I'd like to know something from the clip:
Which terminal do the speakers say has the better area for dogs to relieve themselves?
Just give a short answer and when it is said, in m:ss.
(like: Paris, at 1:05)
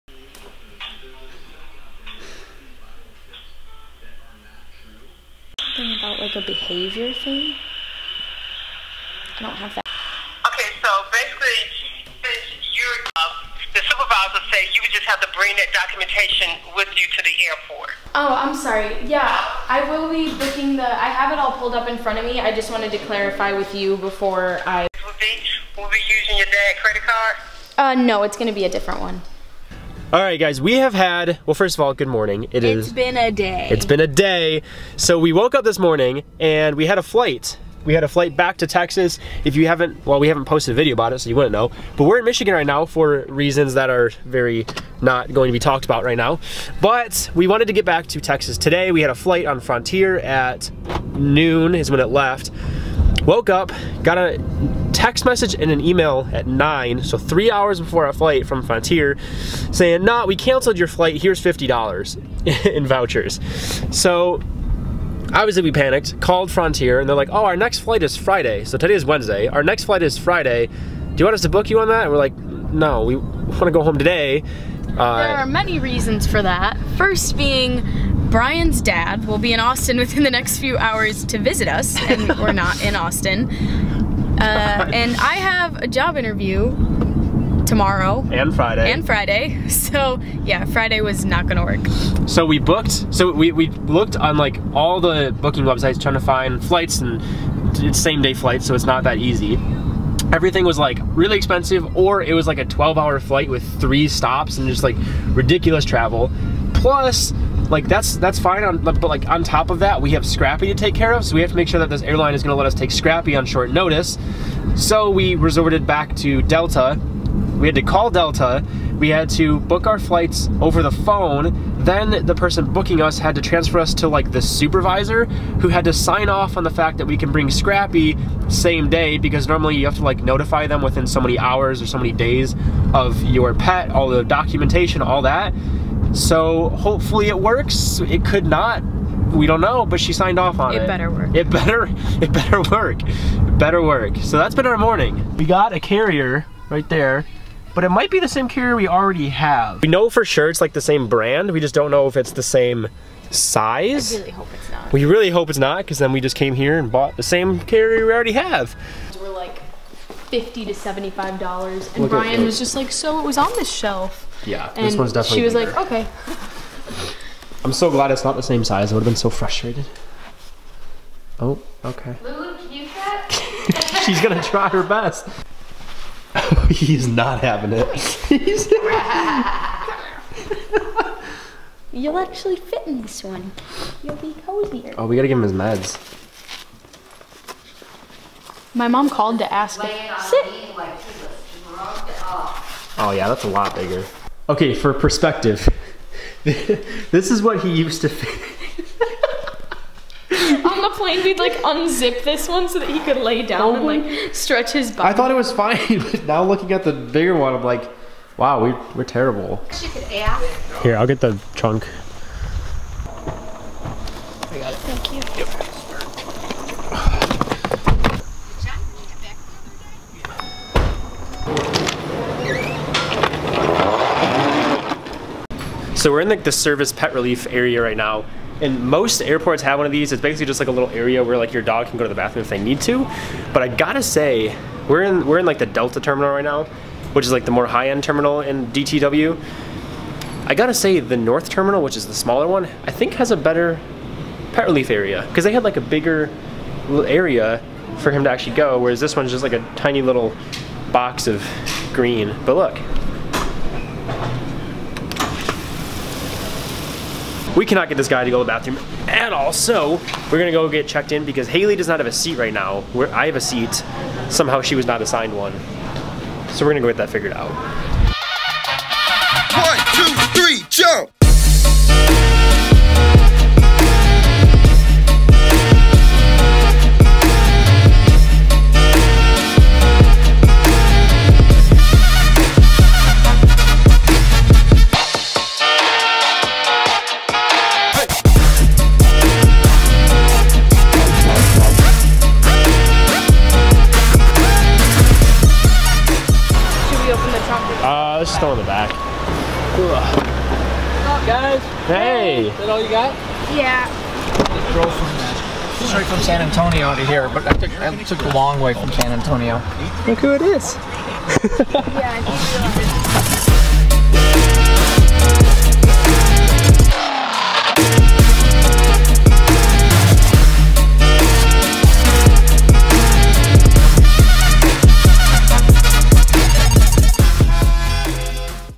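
North terminal, at 4:01.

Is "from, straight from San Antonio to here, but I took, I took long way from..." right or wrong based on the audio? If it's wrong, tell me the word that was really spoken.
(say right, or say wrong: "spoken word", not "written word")
right.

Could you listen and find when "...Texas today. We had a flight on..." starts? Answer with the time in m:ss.
0:48.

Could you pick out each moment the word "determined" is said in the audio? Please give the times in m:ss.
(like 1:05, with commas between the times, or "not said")
not said.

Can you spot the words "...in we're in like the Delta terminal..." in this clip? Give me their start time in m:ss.
3:55.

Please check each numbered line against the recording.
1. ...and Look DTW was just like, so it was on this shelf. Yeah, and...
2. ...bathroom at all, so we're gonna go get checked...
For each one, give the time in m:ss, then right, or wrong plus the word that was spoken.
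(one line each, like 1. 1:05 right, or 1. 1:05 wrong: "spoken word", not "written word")
1. 2:41 wrong: "Bryan", not "DTW"
2. 4:18 right.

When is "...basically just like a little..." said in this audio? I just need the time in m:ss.
3:50.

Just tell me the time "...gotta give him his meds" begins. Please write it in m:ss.
3:05.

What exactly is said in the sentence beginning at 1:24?
Uh, and I have a job interview tomorrow and Friday and Friday.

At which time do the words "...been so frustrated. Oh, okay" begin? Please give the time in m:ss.
2:49.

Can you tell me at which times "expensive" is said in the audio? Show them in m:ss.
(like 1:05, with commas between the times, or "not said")
1:41.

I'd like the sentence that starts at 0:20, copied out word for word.
I have it all pulled up in front of me.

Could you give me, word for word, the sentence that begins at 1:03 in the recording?
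So obviously we panicked, called Frontier, and they're like, oh, our next flight is Friday.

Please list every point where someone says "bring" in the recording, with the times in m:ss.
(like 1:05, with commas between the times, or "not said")
0:15, 2:07.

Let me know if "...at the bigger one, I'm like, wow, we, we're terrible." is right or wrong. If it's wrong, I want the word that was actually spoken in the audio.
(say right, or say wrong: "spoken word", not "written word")
right.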